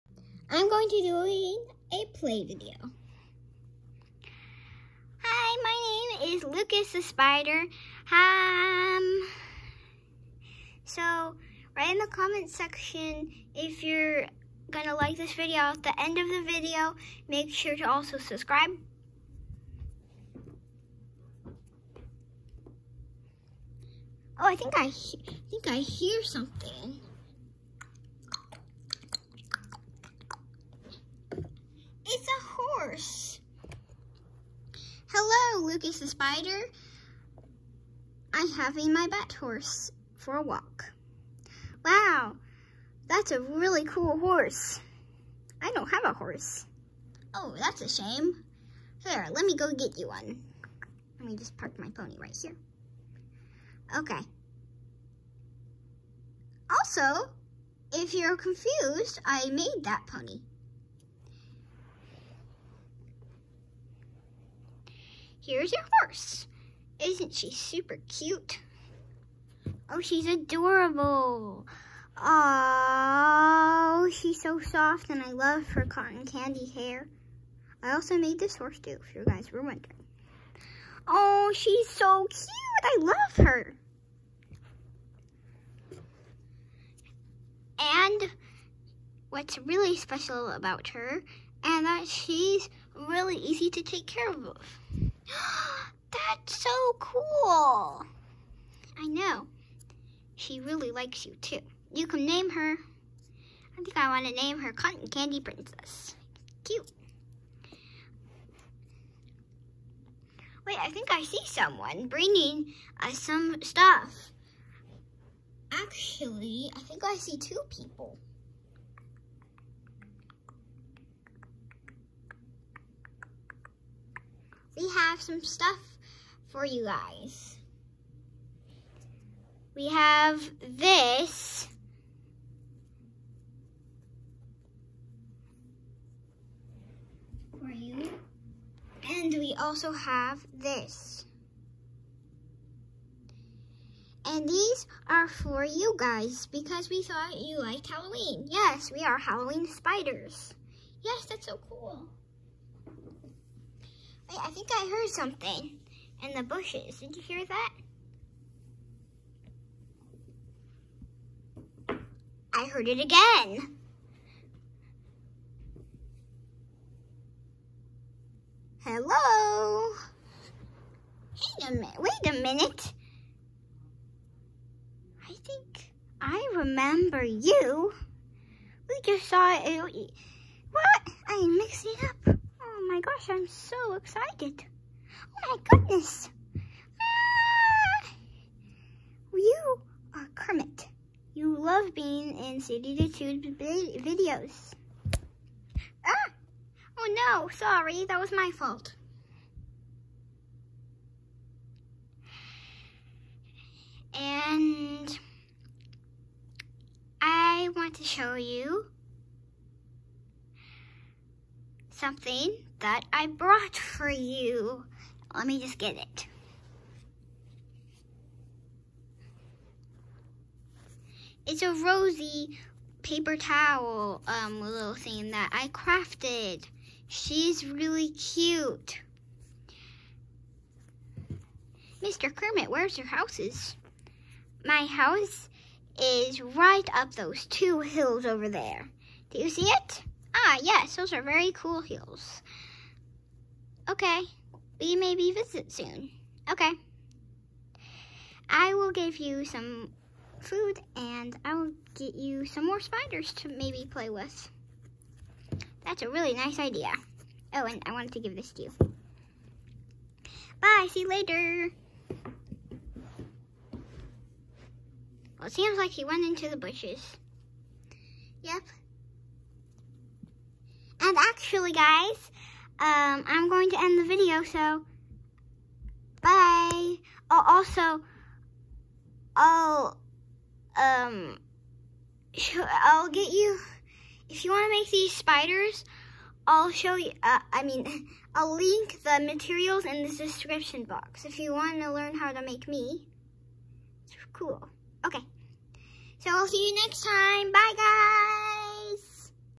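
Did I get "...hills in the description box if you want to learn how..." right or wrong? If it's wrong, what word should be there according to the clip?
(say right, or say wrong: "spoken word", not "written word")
wrong: "materials", not "hills".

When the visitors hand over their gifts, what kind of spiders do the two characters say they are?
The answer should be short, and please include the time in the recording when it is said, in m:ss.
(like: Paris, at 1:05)
Halloween spiders, at 2:29.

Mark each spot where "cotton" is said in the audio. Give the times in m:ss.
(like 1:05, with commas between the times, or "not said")
1:15, 1:44.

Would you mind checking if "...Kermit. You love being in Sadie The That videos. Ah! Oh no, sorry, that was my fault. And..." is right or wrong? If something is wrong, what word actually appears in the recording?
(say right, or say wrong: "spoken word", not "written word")
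wrong: "Tube", not "That".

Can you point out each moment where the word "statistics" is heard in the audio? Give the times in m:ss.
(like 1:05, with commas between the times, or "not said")
not said.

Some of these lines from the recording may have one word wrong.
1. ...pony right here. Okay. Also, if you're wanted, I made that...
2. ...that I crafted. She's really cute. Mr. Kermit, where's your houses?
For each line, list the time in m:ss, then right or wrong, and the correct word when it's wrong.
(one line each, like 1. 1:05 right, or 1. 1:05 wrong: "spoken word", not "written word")
1. 0:51 wrong: "confused", not "wanted"
2. 3:45 right.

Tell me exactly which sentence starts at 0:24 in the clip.
Oh, I think I, I think I hear something.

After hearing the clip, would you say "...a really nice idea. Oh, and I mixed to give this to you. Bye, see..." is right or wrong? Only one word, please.
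wrong.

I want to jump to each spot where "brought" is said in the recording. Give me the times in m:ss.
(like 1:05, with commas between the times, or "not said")
3:33.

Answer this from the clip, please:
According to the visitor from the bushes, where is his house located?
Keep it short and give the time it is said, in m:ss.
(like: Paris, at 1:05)
up those two hills, at 3:56.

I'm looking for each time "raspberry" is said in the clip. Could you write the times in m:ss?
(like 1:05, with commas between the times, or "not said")
not said.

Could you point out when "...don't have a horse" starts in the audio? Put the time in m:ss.
0:45.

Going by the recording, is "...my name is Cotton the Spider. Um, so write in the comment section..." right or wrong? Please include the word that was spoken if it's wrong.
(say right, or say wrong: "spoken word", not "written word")
wrong: "Lucas", not "Cotton".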